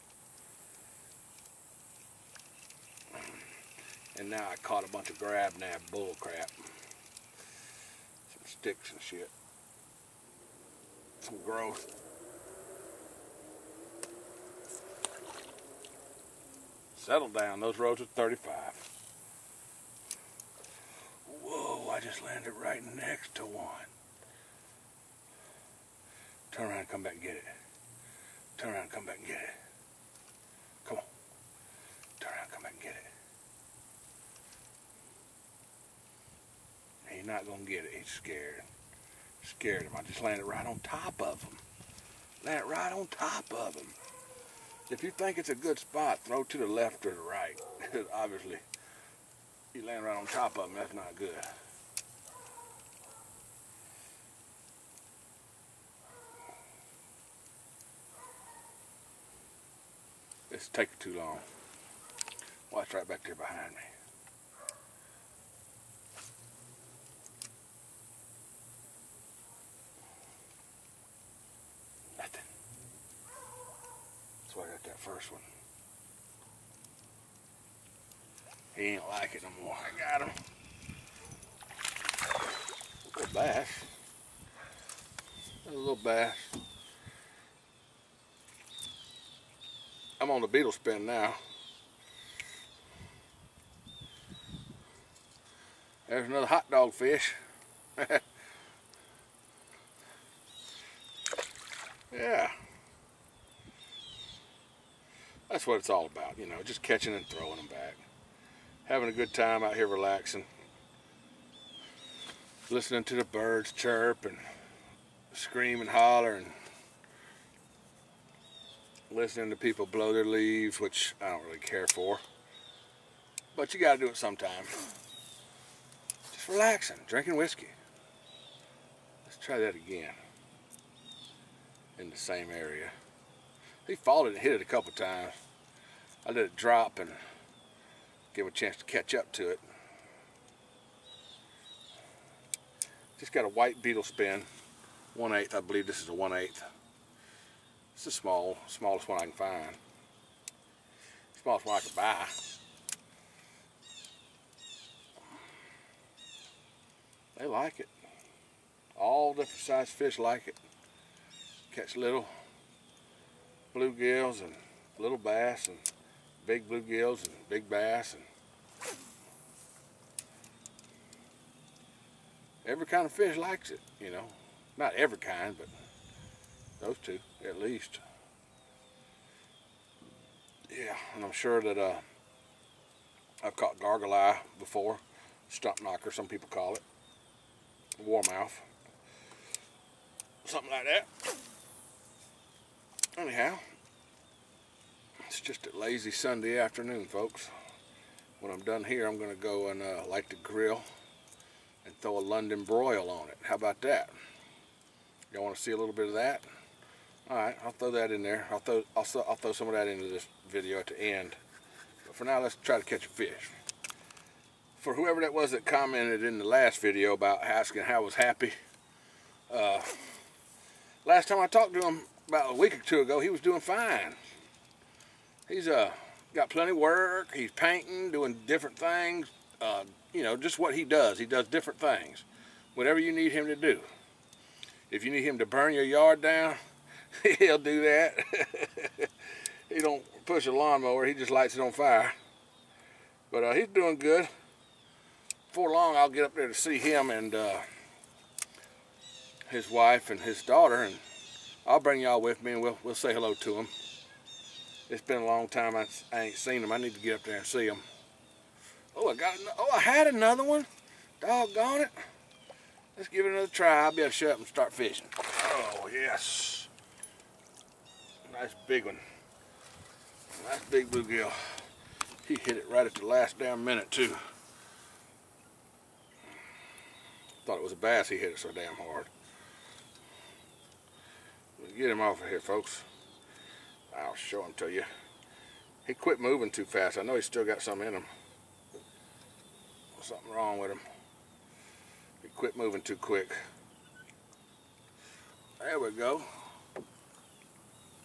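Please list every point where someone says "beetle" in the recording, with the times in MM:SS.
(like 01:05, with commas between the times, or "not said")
01:30, 02:23.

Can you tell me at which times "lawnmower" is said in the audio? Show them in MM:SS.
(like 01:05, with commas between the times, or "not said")
04:00.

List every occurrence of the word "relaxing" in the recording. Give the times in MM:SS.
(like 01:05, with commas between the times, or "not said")
01:49, 02:06.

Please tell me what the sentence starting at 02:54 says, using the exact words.
Not every kind, but those two, at least.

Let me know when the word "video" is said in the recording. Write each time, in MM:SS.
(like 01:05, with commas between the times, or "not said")
03:30, 03:36.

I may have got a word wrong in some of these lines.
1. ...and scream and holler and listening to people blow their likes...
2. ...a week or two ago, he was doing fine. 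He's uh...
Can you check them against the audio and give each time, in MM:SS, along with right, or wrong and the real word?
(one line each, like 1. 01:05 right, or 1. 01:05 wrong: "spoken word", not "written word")
1. 01:54 wrong: "leaves", not "likes"
2. 03:42 right.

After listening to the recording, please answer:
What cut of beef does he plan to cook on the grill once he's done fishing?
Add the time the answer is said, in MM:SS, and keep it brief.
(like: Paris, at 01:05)
London broil, at 03:22.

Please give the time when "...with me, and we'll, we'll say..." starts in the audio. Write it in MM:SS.
04:12.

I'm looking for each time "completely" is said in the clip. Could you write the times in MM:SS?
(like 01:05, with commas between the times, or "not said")
not said.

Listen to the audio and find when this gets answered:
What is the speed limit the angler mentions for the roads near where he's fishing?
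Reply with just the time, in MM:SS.
00:18.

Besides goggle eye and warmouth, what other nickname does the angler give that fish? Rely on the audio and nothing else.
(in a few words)
Stump knocker.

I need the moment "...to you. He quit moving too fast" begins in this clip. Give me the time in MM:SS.
04:44.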